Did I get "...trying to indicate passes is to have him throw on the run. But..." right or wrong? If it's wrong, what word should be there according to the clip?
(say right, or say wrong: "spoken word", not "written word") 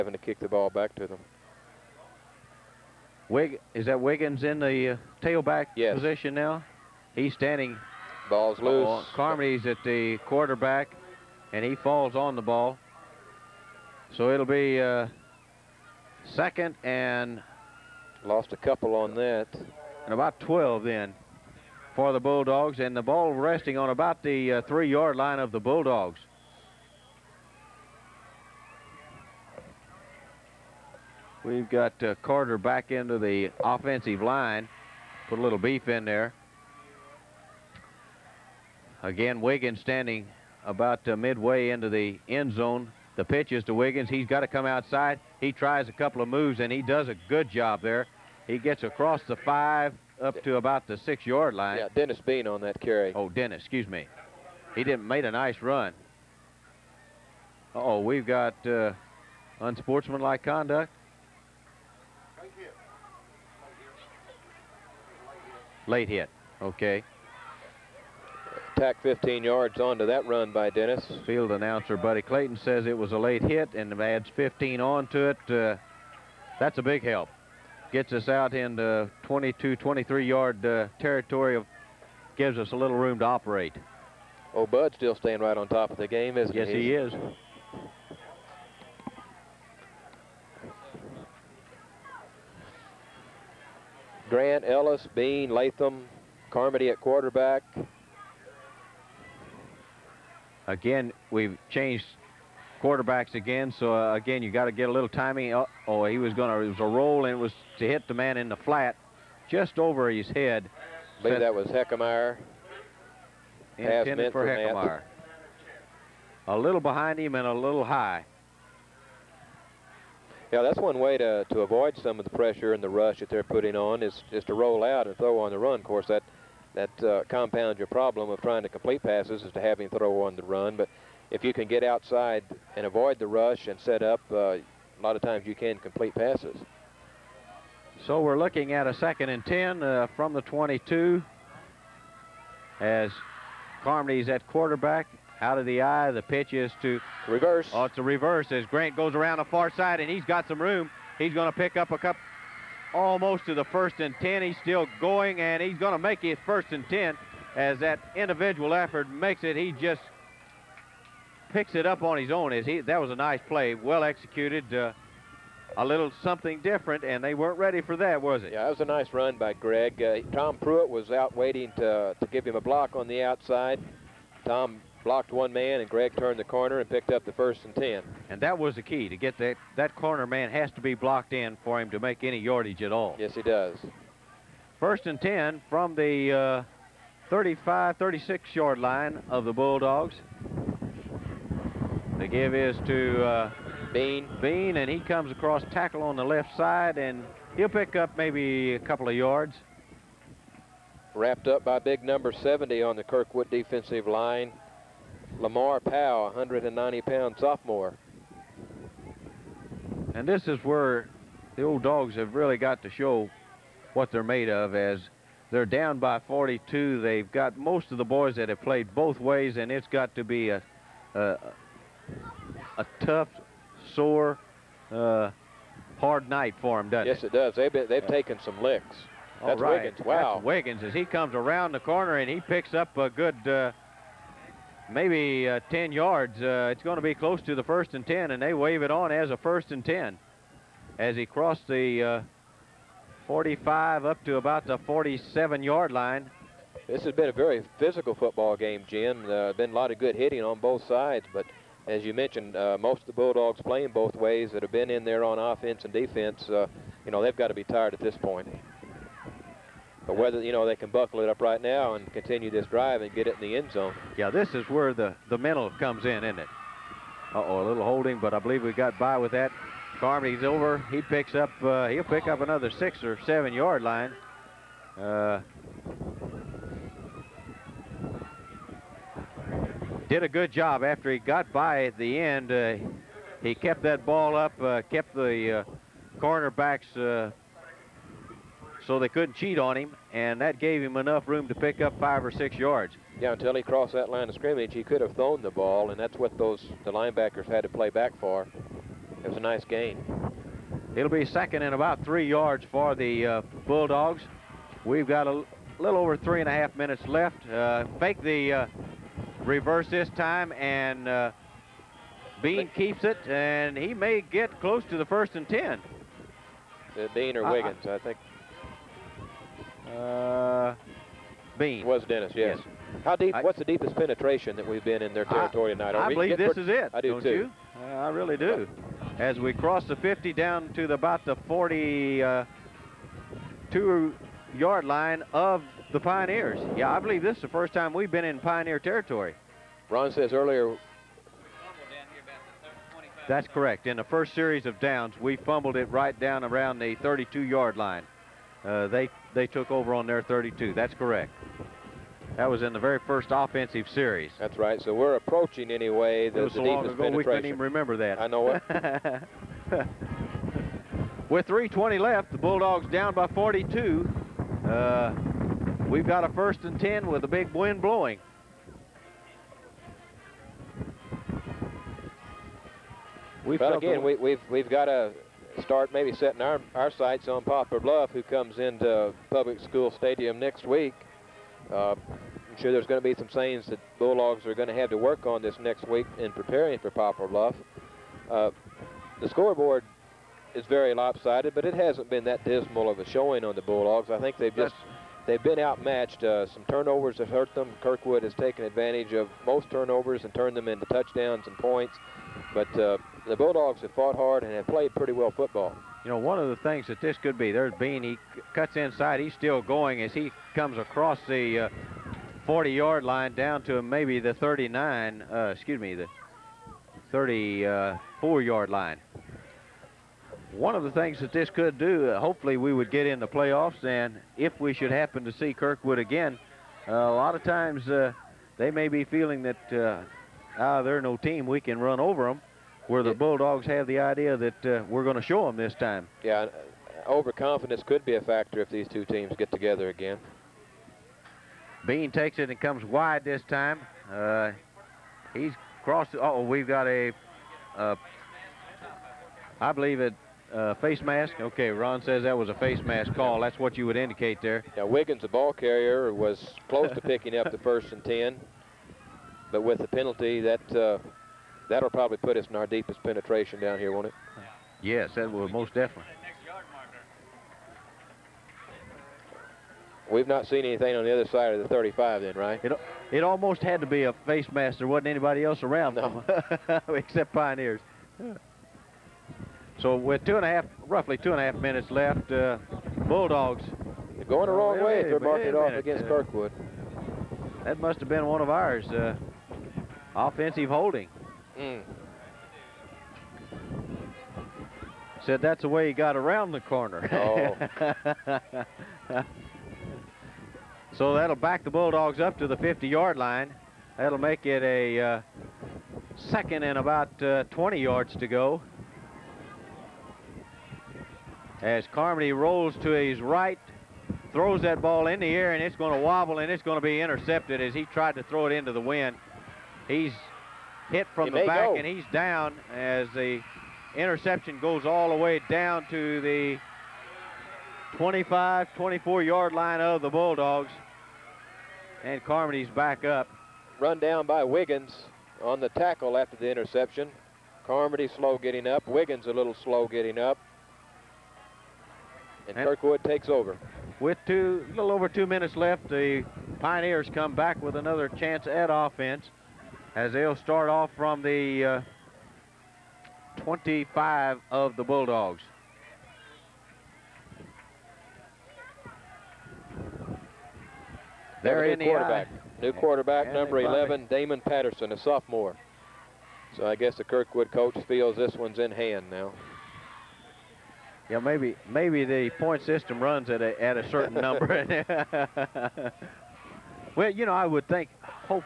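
wrong: "complete", not "indicate".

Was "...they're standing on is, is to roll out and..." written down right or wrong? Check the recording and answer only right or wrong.
wrong.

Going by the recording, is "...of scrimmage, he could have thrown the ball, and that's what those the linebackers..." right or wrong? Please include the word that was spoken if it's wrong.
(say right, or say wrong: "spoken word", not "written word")
right.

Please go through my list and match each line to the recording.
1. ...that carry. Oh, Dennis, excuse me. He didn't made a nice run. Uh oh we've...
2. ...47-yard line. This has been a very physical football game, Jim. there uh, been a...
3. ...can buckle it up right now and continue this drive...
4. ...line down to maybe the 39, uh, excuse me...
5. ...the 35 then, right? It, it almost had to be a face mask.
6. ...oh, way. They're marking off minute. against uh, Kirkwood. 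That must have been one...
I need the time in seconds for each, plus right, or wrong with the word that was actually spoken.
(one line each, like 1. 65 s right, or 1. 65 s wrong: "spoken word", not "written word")
1. 52 s right
2. 244 s right
3. 260 s right
4. 413 s right
5. 471 s right
6. 484 s right.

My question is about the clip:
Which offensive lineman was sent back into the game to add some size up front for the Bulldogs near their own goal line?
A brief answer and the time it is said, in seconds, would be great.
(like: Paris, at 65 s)
Carter, at 32 s.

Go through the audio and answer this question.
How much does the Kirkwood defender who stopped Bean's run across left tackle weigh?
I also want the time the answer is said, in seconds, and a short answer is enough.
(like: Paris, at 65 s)
190, at 206 s.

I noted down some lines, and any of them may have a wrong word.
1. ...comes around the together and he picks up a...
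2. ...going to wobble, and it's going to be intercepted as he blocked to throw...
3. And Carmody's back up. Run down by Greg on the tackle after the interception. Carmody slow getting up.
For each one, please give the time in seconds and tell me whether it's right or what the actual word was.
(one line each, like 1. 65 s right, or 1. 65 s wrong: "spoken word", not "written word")
1. 231 s wrong: "corner", not "together"
2. 515 s wrong: "tried", not "blocked"
3. 532 s wrong: "Wiggins", not "Greg".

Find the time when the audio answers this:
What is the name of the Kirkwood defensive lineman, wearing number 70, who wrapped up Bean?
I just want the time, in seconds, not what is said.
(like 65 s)
205 s.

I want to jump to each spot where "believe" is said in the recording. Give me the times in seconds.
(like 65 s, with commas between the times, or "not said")
111 s, 268 s, 326 s, 337 s, 449 s.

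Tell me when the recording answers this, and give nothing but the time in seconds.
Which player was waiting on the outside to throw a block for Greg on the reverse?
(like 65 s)
170 s.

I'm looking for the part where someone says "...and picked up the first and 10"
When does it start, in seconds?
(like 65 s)
176 s.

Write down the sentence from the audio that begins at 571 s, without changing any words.
Yeah, maybe maybe the point system runs at a at a certain number.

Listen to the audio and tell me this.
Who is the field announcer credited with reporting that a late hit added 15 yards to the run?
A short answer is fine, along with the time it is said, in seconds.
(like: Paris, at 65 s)
Buddy Clayton, at 71 s.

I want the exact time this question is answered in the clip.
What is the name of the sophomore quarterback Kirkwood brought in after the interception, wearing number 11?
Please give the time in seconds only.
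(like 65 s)
564 s.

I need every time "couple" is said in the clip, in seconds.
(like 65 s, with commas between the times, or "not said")
18 s, 45 s, 151 s, 198 s.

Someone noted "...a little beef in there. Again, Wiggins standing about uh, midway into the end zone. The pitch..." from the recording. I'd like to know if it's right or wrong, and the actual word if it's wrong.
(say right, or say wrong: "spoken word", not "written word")
right.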